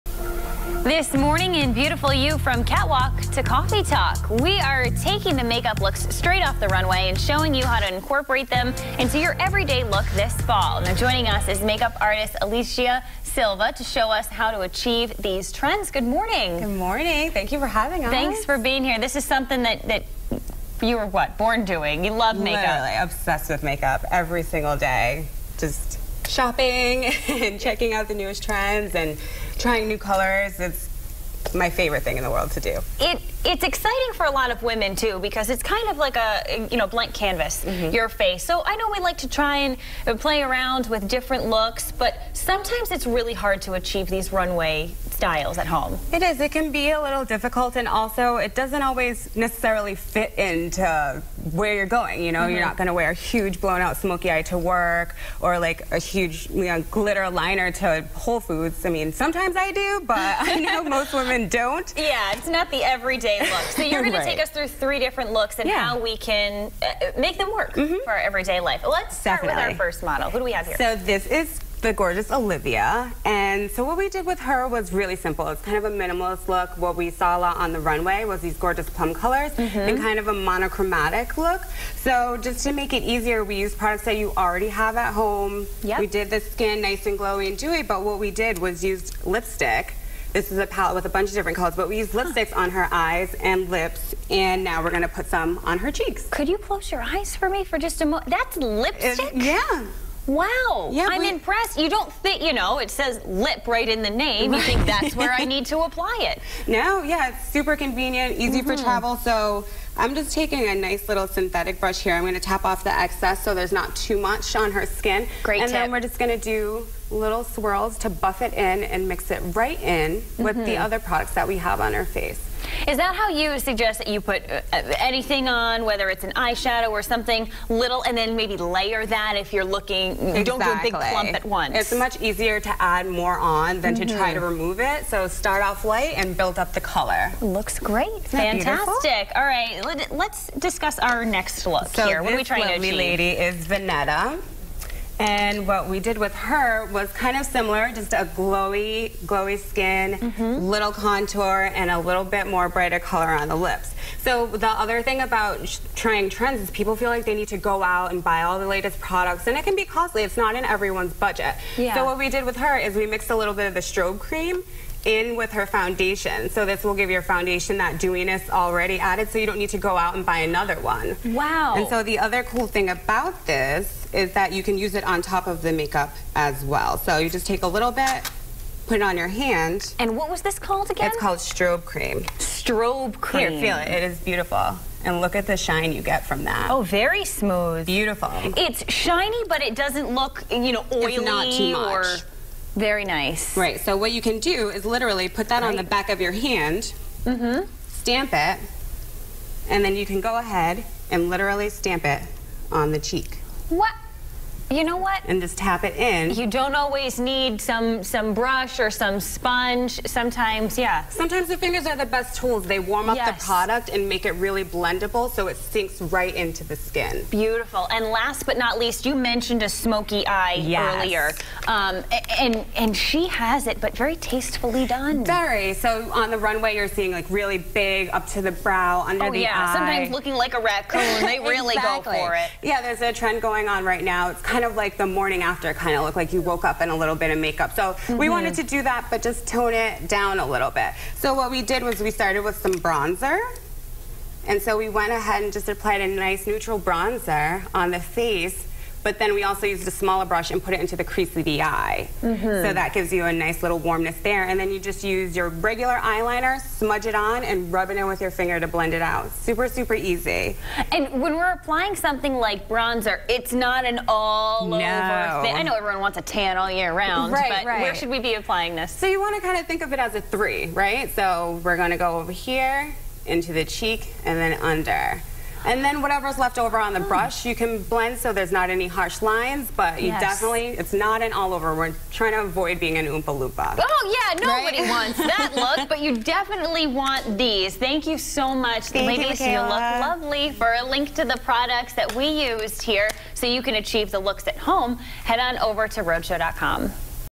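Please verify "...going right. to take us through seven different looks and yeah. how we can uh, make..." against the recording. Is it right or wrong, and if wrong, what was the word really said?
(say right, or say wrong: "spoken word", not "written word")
wrong: "three", not "seven".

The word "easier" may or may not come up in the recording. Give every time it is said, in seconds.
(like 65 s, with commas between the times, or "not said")
83 s, 132 s.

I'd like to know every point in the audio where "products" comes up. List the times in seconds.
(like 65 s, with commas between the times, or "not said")
83 s, 121 s, 159 s, 213 s, 291 s.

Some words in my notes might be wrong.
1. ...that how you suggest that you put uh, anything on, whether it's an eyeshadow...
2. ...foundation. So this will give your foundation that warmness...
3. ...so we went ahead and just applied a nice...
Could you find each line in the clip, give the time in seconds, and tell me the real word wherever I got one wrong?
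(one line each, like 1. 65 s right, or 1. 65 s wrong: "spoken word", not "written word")
1. 122 s right
2. 165 s wrong: "dewiness", not "warmness"
3. 244 s right.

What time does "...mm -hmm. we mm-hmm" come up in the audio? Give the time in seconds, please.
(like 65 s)
237 s.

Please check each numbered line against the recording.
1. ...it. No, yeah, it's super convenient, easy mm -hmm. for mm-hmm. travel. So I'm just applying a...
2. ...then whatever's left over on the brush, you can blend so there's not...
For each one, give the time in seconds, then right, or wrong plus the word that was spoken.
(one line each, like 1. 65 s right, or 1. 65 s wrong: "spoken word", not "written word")
1. 106 s wrong: "taking", not "applying"
2. 275 s right.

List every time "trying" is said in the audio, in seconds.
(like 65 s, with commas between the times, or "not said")
29 s, 142 s, 156 s, 282 s.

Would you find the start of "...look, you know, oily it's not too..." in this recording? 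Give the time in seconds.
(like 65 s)
190 s.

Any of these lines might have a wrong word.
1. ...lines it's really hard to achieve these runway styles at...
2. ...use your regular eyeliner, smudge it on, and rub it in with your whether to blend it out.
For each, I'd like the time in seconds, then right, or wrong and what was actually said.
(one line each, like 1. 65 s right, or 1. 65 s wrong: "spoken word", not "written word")
1. 42 s wrong: "sometimes", not "lines"
2. 255 s wrong: "finger", not "whether".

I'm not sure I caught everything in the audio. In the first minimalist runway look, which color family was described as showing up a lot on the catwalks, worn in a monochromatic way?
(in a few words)
Plum.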